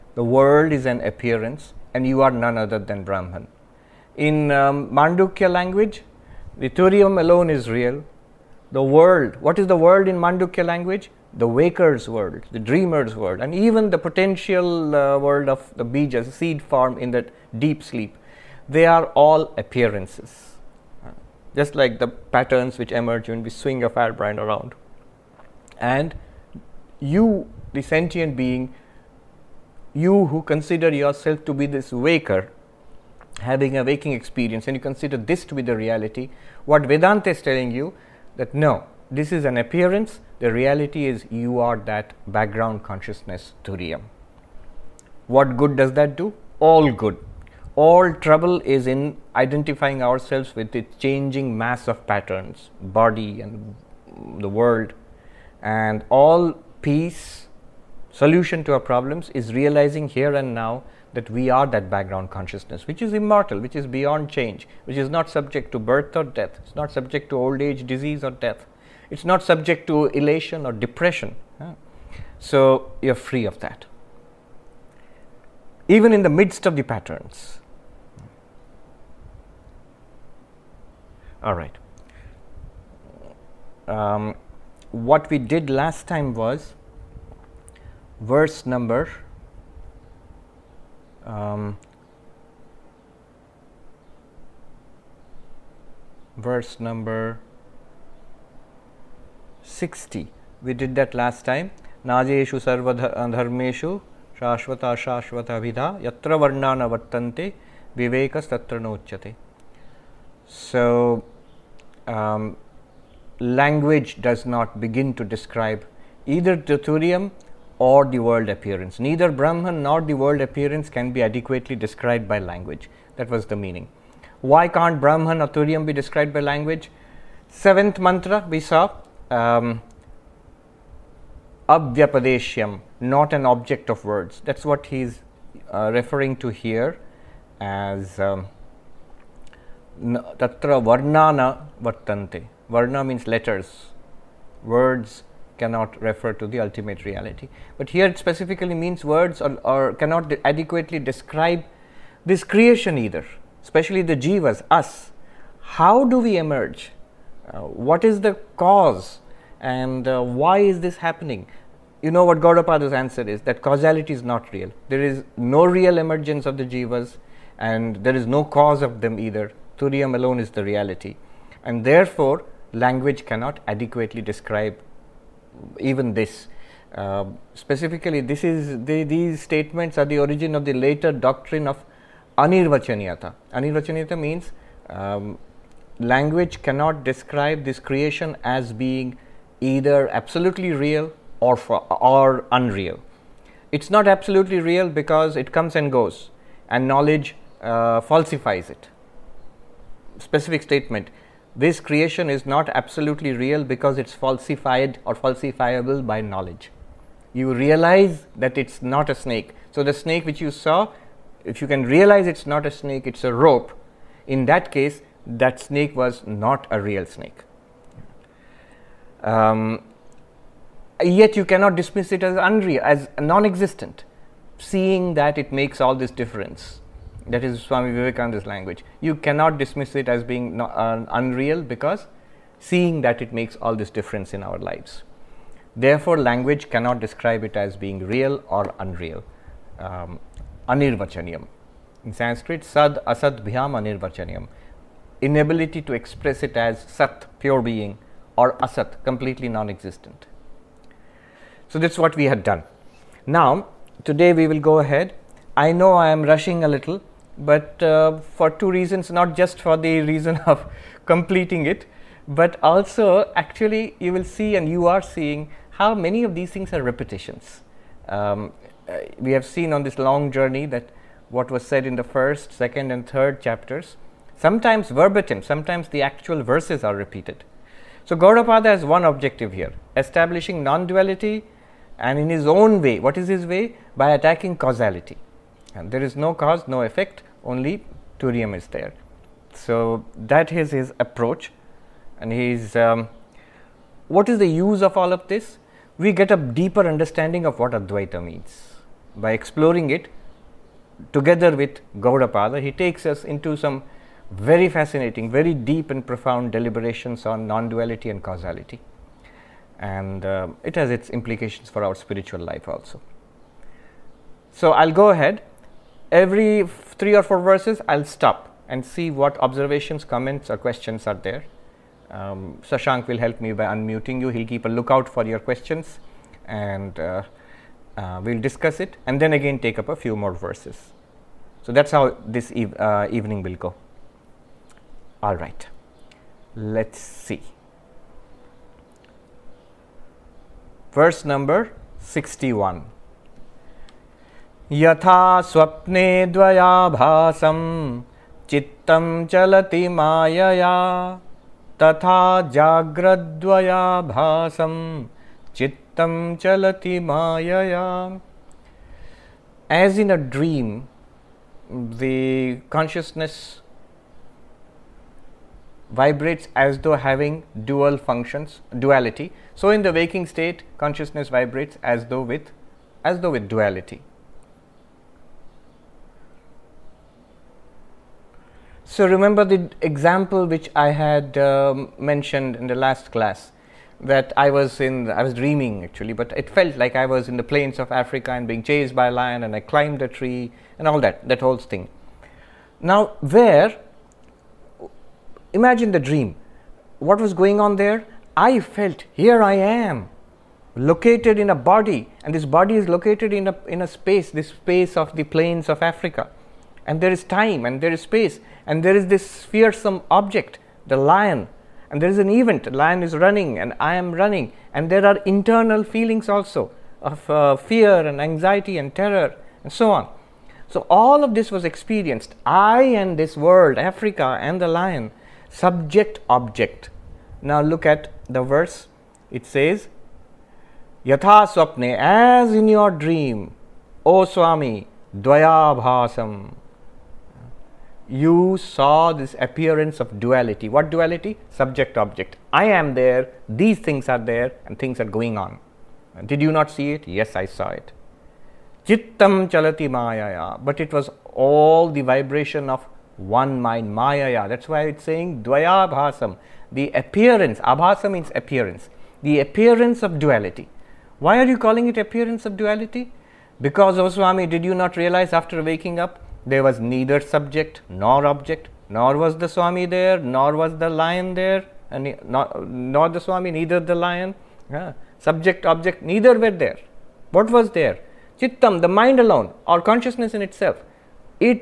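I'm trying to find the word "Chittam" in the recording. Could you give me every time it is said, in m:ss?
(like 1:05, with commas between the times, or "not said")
7:28, 7:58.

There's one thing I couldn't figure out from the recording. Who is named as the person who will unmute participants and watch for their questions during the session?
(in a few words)
Shashank.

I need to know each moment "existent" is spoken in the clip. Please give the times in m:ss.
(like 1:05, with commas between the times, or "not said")
3:43, 4:09.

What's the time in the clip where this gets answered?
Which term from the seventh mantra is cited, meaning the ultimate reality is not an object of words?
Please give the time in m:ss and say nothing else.
2:11.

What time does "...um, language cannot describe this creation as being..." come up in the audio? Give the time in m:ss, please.
3:04.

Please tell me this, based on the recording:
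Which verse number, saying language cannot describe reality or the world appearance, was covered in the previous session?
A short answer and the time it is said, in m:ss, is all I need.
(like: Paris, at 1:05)
60, at 1:36.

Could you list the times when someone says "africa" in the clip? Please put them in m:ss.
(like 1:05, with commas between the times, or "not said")
6:27, 6:45, 7:03.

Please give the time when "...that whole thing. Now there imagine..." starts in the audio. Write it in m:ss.
6:31.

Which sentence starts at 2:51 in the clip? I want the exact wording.
And therefore, language cannot adequately describe even this.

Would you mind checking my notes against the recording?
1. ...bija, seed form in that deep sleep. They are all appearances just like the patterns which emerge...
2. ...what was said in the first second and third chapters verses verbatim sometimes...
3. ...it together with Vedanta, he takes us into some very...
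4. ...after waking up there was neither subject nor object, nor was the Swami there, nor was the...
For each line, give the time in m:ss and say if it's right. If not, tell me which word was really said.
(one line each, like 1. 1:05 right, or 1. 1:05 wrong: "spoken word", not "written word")
1. 0:15 right
2. 4:31 wrong: "sometimes", not "verses"
3. 4:59 wrong: "Gaudapada", not "Vedanta"
4. 7:45 right.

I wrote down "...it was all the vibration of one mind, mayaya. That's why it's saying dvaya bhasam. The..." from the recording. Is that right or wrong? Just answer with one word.
right.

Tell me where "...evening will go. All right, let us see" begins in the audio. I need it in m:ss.
5:33.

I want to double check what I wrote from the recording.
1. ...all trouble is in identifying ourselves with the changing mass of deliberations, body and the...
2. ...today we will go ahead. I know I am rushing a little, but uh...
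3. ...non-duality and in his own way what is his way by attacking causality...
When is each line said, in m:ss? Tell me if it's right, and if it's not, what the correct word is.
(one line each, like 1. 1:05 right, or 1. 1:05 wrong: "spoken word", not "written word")
1. 0:47 wrong: "patterns", not "deliberations"
2. 4:14 right
3. 4:40 right.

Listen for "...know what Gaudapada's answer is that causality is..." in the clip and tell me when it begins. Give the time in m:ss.
2:42.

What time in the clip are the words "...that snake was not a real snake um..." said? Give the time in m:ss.
3:35.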